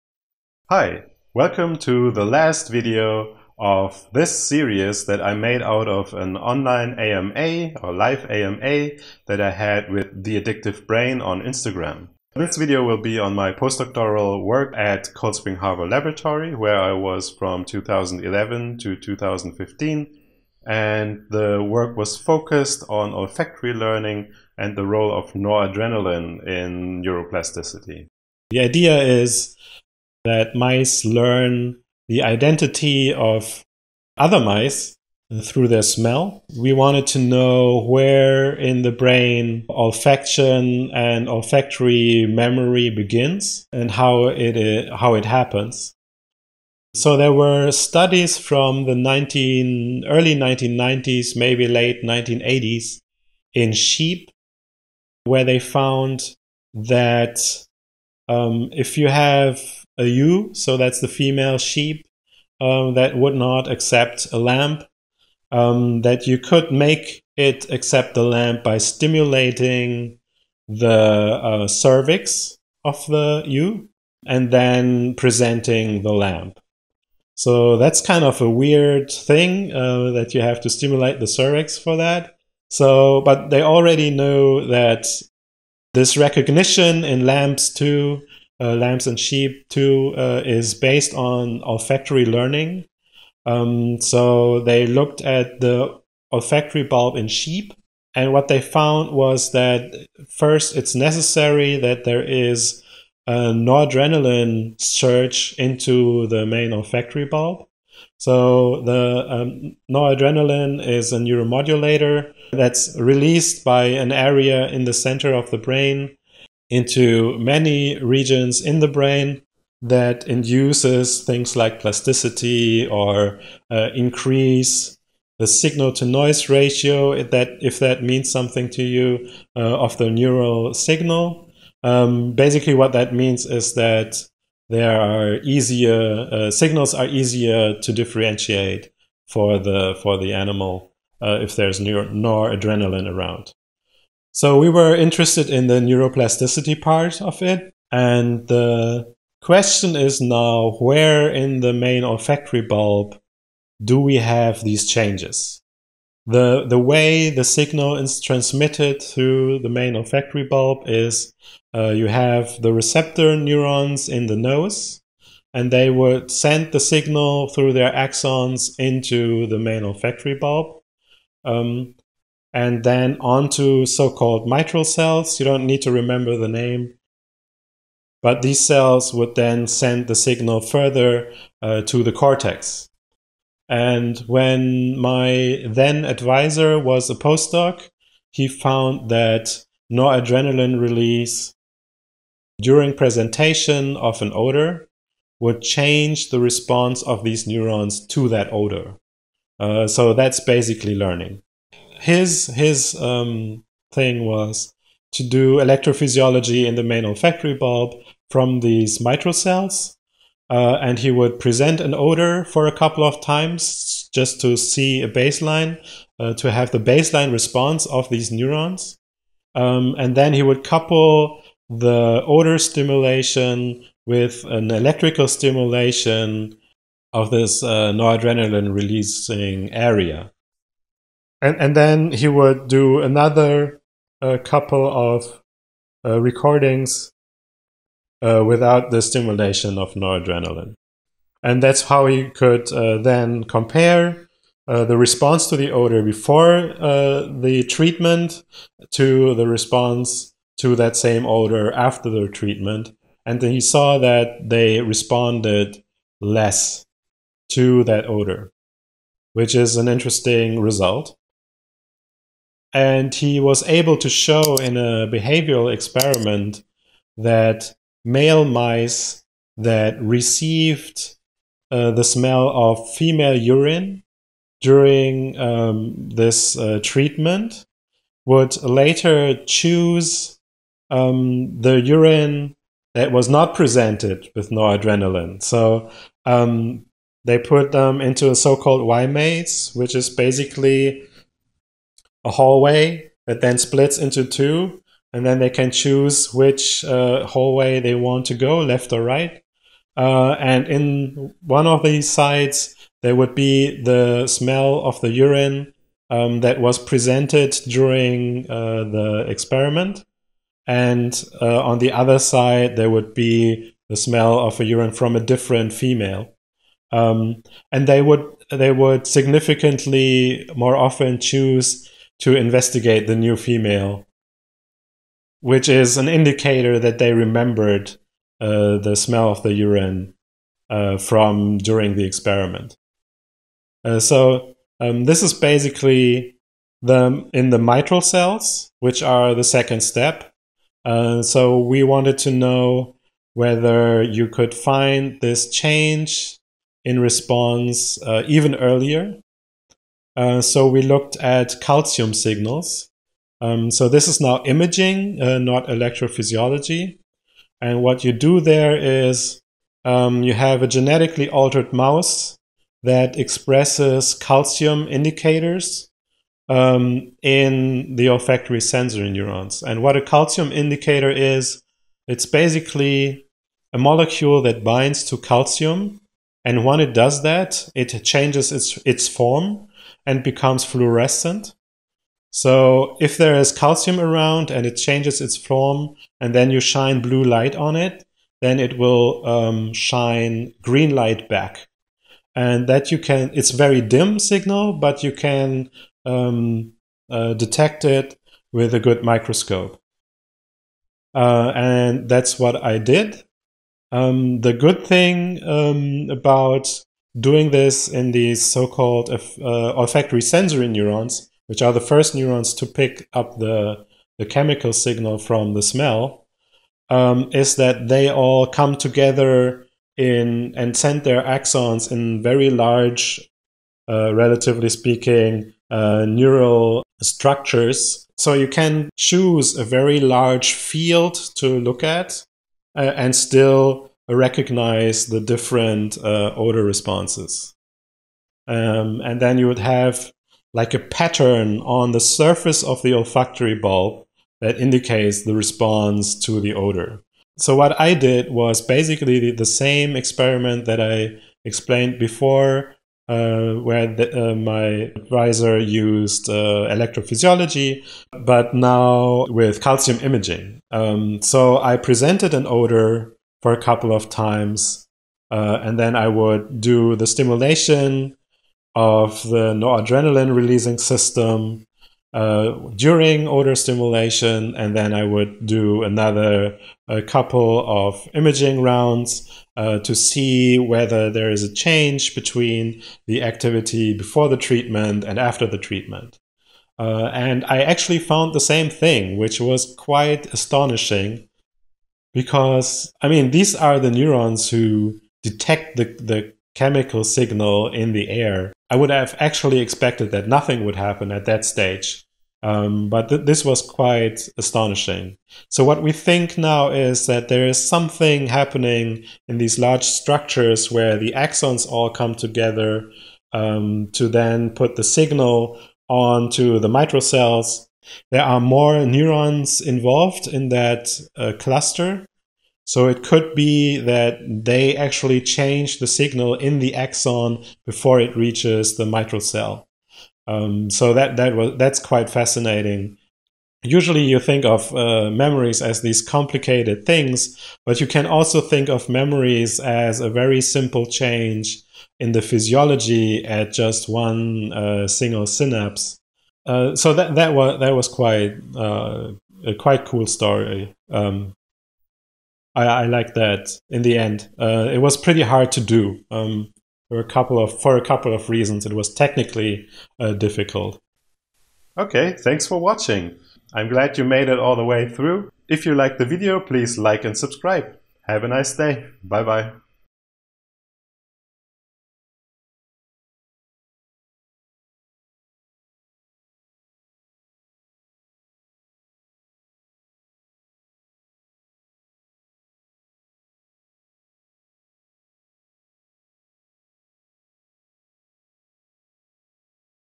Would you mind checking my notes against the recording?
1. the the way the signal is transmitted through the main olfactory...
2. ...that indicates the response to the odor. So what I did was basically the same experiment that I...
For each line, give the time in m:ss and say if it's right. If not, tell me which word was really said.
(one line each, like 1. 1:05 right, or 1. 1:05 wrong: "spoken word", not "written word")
1. 2:36 right
2. 7:24 right.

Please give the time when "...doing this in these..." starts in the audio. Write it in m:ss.
6:47.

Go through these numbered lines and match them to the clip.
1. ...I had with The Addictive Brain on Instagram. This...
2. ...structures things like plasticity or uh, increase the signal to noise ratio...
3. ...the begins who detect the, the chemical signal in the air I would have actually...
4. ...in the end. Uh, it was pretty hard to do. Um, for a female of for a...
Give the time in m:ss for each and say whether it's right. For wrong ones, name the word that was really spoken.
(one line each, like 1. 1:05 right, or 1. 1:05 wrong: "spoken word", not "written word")
1. 0:09 right
2. 2:00 wrong: "induces", not "structures"
3. 8:13 wrong: "neurons", not "begins"
4. 9:13 wrong: "couple", not "female".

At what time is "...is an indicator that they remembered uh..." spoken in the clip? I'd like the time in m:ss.
5:25.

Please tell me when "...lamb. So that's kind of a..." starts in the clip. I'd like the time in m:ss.
1:16.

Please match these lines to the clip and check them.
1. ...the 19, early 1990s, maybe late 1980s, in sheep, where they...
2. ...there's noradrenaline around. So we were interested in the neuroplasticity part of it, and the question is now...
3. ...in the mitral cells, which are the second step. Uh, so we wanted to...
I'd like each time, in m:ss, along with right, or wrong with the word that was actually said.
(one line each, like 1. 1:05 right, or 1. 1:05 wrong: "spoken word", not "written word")
1. 0:48 right
2. 2:21 right
3. 5:37 right.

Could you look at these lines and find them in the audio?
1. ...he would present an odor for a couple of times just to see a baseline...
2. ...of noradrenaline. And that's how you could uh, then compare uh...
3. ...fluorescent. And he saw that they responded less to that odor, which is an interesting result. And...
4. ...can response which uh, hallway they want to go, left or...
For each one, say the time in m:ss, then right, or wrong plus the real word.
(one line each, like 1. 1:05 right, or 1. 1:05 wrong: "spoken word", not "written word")
1. 3:30 right
2. 3:59 right
3. 4:12 wrong: "treatment", not "fluorescent"
4. 4:55 wrong: "choose", not "response".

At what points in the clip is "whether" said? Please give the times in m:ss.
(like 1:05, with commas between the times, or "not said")
5:43, 8:00.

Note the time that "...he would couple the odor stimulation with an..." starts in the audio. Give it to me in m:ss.
3:40.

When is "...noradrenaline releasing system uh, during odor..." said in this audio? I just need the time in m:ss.
7:49.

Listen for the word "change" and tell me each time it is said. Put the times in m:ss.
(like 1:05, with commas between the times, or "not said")
2:34, 3:15, 5:45, 6:18, 6:24, 8:01, 8:45, 9:00.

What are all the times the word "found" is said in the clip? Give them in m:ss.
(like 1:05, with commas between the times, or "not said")
0:55, 1:38, 3:08, 8:07.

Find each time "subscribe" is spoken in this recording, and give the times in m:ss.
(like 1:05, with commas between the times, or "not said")
9:27.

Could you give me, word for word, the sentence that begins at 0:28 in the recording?
The idea is that mice learn the identity of other mice through their smell.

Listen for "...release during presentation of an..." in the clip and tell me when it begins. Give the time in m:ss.
3:10.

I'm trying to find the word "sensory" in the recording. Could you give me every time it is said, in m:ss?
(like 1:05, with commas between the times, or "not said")
6:08, 6:50.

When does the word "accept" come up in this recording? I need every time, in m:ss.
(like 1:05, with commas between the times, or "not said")
1:03, 1:07.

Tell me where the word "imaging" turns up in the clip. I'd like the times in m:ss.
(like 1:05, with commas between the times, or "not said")
5:54, 7:40, 7:58.